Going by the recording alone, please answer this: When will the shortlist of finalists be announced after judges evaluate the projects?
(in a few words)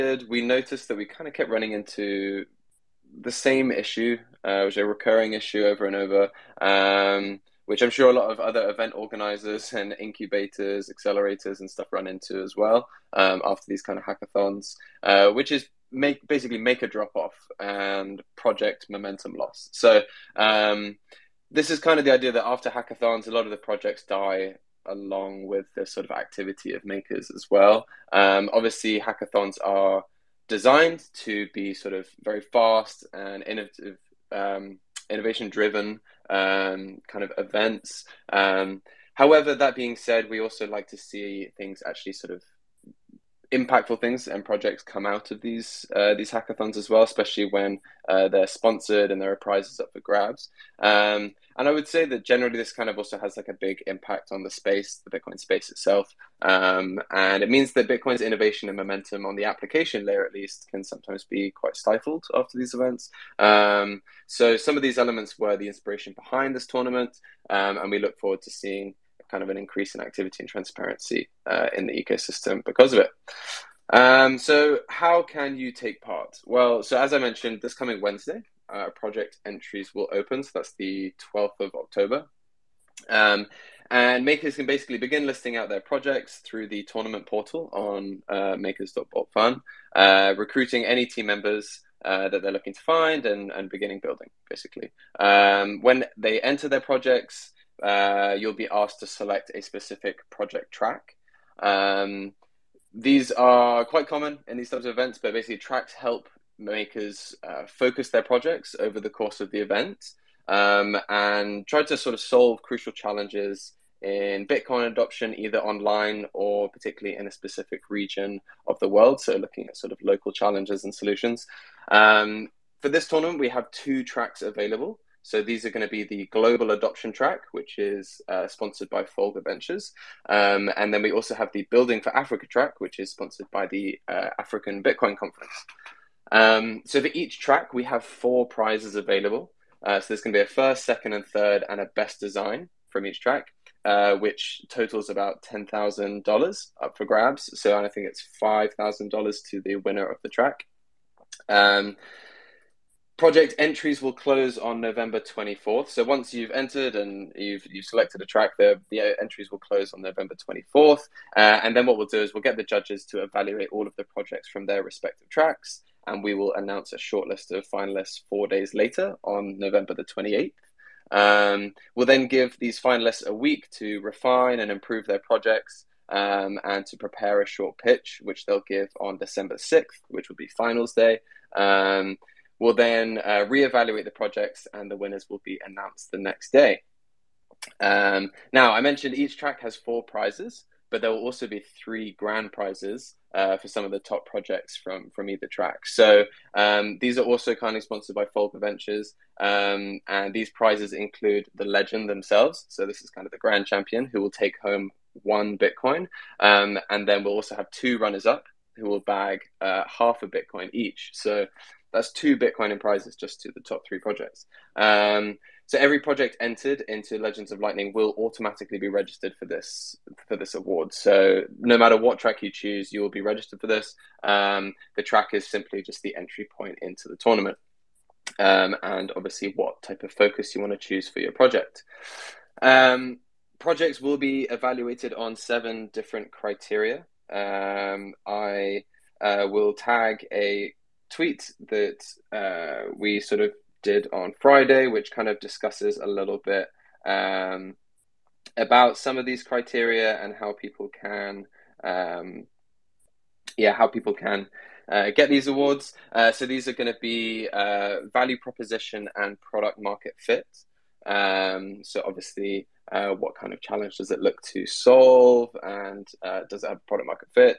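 November 28th.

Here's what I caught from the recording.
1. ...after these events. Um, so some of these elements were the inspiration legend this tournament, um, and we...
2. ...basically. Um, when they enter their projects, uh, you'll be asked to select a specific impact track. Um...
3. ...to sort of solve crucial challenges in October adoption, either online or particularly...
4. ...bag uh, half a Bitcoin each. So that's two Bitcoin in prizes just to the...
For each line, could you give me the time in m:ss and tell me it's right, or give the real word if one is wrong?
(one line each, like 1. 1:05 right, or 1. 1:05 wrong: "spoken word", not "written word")
1. 1:02 wrong: "behind", not "legend"
2. 1:34 wrong: "project", not "impact"
3. 1:51 wrong: "Bitcoin", not "October"
4. 3:28 right.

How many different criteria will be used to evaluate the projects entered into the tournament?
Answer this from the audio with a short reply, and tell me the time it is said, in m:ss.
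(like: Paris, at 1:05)
7, at 3:55.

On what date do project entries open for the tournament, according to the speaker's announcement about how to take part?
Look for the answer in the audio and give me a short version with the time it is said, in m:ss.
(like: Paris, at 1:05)
12th of October, at 1:21.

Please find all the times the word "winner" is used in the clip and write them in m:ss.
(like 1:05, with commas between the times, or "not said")
2:29, 3:04.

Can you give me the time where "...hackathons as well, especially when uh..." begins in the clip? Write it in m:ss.
0:46.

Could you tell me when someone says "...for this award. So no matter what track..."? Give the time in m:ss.
3:40.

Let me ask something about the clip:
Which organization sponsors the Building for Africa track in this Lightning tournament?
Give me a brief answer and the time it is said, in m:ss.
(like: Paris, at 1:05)
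African Bitcoin Conference, at 2:14.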